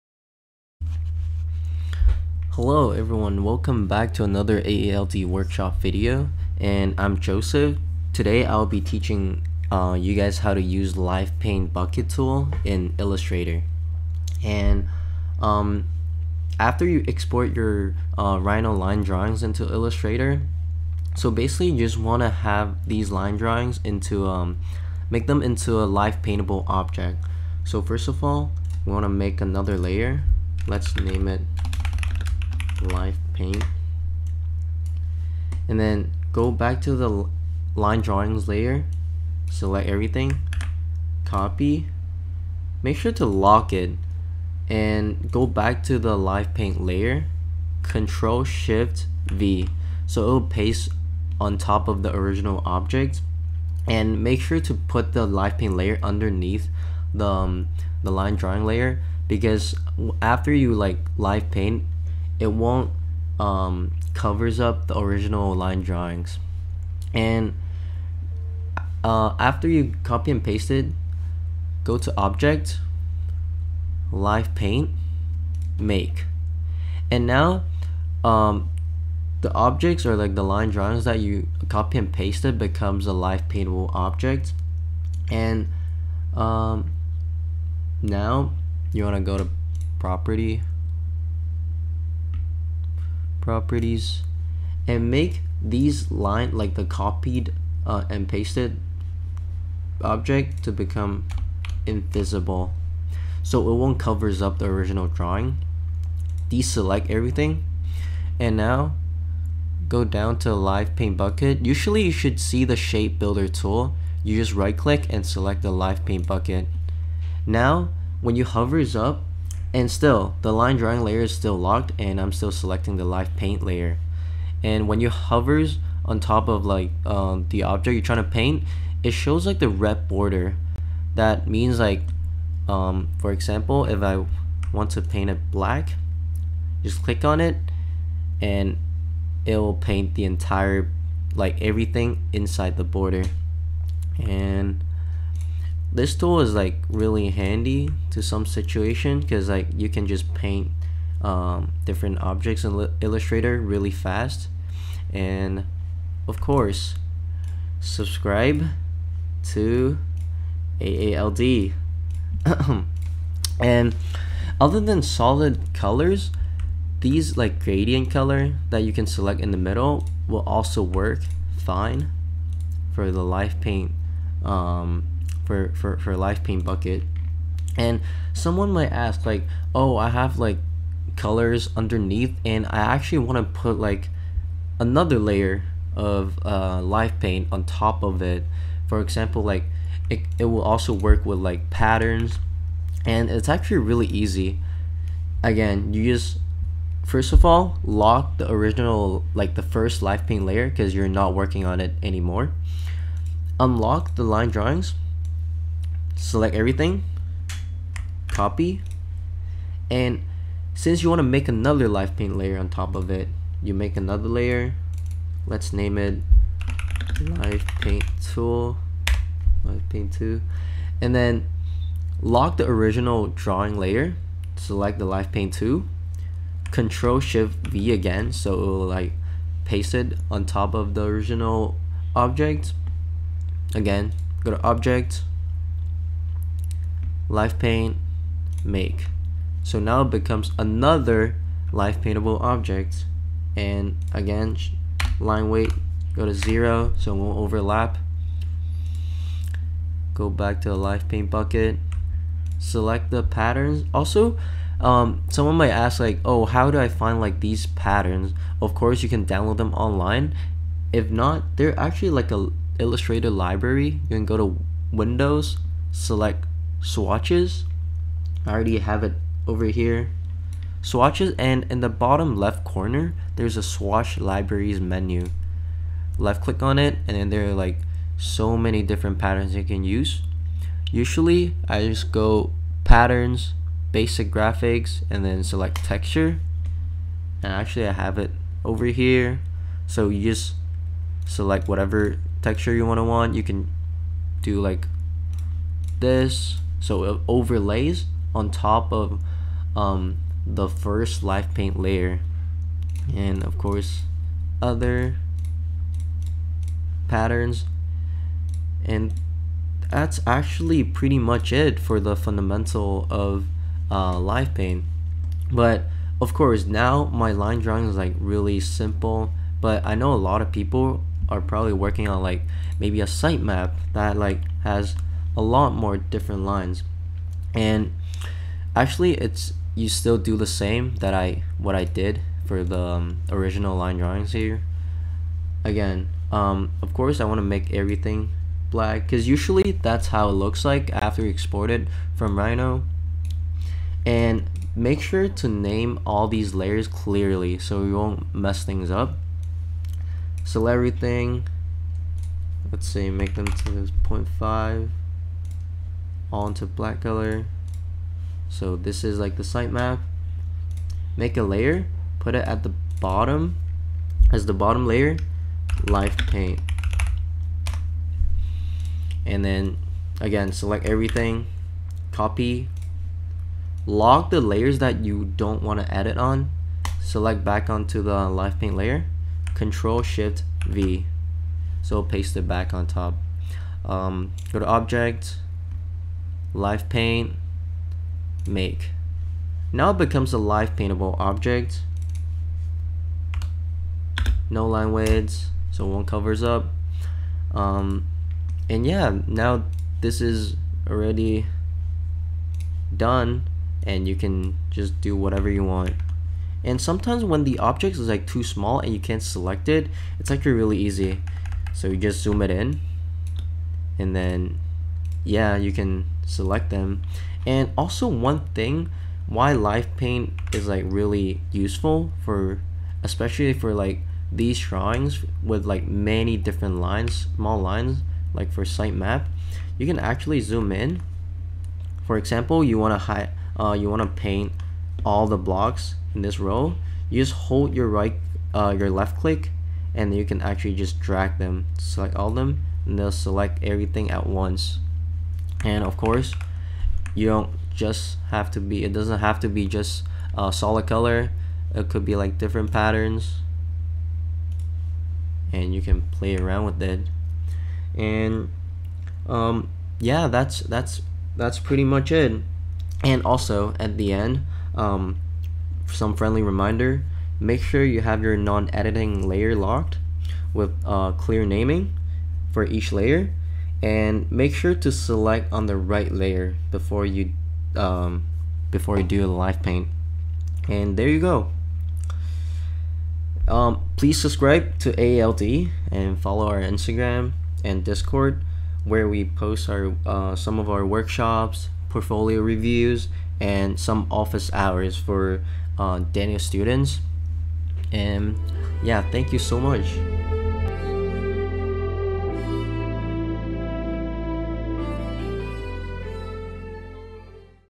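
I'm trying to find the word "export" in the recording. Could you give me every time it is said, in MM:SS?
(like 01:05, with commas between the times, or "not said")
00:17, 05:41.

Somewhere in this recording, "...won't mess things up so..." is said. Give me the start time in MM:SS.
05:47.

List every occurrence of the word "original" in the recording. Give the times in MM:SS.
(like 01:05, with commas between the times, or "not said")
00:52, 01:04, 01:44, 03:18, 03:42, 03:51, 05:33.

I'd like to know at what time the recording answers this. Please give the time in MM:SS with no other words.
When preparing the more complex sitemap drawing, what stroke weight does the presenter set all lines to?
05:53.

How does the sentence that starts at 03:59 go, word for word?
So now it becomes another live paintable object.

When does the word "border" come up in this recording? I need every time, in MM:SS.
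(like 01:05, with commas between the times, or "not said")
02:10, 02:22.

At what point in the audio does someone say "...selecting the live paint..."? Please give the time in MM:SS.
02:02.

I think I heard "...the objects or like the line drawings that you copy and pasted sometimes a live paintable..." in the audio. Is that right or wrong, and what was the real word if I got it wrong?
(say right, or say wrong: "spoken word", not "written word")
wrong: "becomes", not "sometimes".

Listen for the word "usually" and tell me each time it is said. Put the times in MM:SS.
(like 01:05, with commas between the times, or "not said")
01:51, 04:40, 05:39.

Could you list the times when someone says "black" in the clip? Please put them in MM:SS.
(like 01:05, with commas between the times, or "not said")
02:15, 05:38, 05:56.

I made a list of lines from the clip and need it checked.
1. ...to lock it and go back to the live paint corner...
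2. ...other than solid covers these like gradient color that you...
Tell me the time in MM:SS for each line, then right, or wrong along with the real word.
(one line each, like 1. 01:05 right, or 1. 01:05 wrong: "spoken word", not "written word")
1. 00:43 wrong: "layer", not "corner"
2. 02:44 wrong: "colors", not "covers".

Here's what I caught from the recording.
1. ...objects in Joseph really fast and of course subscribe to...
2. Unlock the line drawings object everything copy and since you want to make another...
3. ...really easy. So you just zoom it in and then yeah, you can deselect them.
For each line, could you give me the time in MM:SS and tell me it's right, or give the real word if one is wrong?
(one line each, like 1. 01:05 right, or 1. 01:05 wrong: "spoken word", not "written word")
1. 02:32 wrong: "Illustrator", not "Joseph"
2. 03:23 wrong: "select", not "object"
3. 06:50 wrong: "select", not "deselect".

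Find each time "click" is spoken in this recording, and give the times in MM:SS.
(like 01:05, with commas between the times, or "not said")
01:54, 02:17, 04:36, 07:19.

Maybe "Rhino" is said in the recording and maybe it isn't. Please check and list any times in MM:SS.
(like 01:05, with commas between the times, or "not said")
00:18, 05:42.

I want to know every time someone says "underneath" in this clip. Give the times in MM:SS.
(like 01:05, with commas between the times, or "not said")
00:56, 03:01.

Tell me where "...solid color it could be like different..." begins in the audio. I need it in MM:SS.
07:30.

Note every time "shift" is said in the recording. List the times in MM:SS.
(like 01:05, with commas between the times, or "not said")
00:48, 03:47, 06:20.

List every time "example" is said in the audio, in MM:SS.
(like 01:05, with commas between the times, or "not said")
02:13, 03:09, 07:12.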